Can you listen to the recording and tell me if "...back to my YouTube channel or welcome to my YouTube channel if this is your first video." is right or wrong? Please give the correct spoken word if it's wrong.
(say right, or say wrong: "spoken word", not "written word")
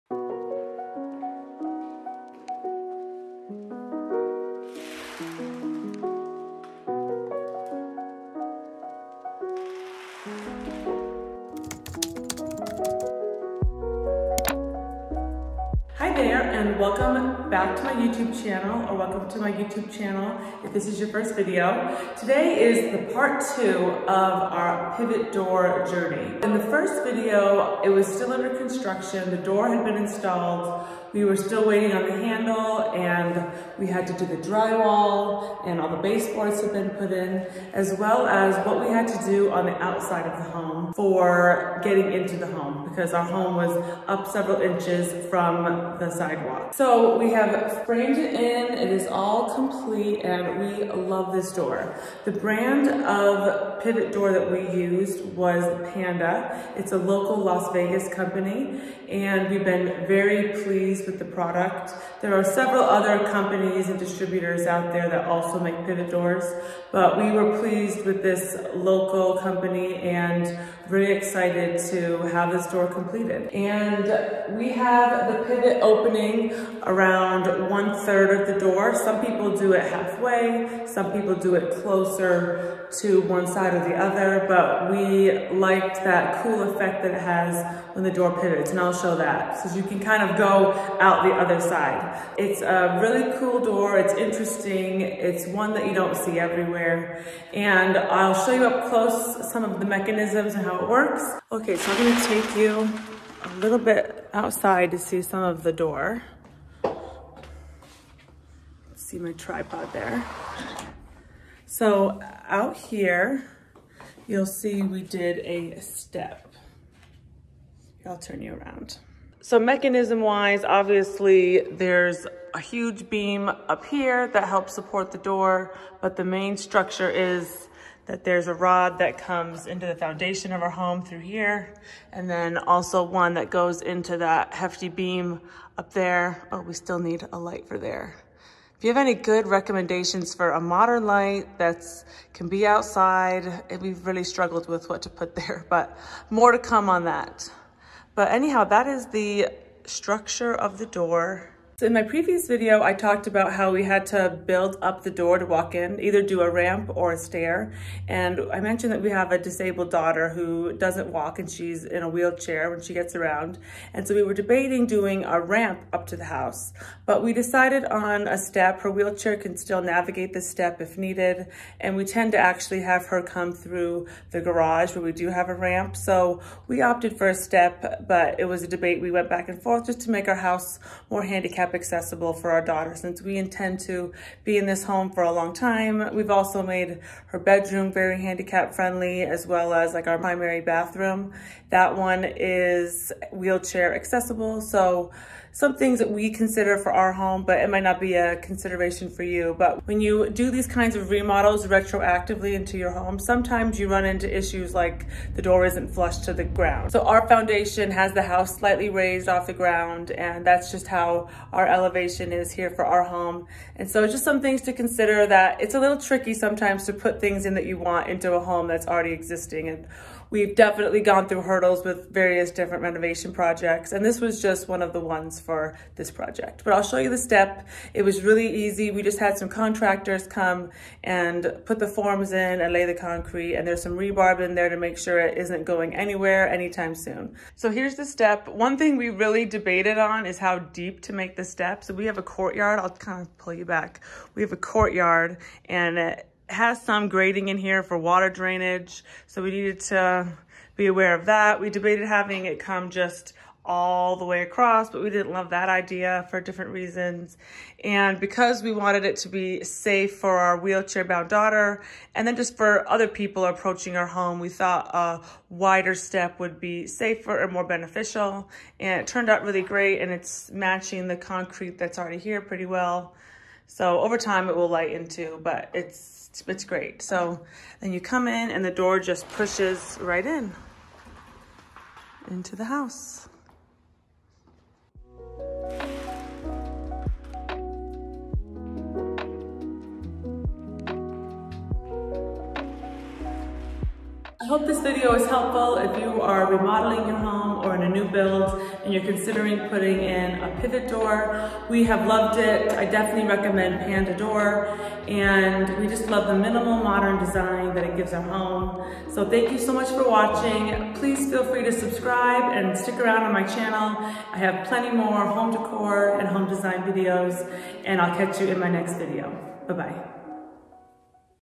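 right.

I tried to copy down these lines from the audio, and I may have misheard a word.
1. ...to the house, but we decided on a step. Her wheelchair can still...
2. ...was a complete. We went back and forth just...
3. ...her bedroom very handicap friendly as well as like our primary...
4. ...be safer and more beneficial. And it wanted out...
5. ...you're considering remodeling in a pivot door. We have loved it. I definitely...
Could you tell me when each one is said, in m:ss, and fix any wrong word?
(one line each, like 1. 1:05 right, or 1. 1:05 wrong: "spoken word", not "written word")
1. 2:46 right
2. 2:58 wrong: "debate", not "complete"
3. 3:07 right
4. 4:26 wrong: "turned", not "wanted"
5. 4:58 wrong: "putting", not "remodeling".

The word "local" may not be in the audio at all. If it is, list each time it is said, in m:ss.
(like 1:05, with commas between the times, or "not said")
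0:56, 1:08.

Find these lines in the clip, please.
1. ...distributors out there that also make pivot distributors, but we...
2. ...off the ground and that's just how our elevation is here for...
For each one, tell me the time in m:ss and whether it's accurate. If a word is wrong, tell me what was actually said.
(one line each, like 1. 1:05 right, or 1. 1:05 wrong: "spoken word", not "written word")
1. 1:03 wrong: "doors", not "distributors"
2. 3:29 right.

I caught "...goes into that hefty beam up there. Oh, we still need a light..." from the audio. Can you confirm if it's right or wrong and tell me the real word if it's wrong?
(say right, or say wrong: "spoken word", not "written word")
right.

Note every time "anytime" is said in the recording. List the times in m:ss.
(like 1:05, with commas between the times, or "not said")
3:56.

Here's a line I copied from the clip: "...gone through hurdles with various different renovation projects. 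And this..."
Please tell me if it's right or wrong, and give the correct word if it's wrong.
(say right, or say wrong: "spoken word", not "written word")
right.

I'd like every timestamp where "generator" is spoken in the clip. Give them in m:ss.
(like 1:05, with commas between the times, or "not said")
not said.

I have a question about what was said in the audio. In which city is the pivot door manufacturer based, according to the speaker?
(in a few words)
Las Vegas.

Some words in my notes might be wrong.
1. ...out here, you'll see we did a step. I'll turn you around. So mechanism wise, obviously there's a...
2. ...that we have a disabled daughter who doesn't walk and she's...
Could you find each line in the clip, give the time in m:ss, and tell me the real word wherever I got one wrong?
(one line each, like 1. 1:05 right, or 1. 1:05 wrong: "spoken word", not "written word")
1. 1:52 right
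2. 2:38 right.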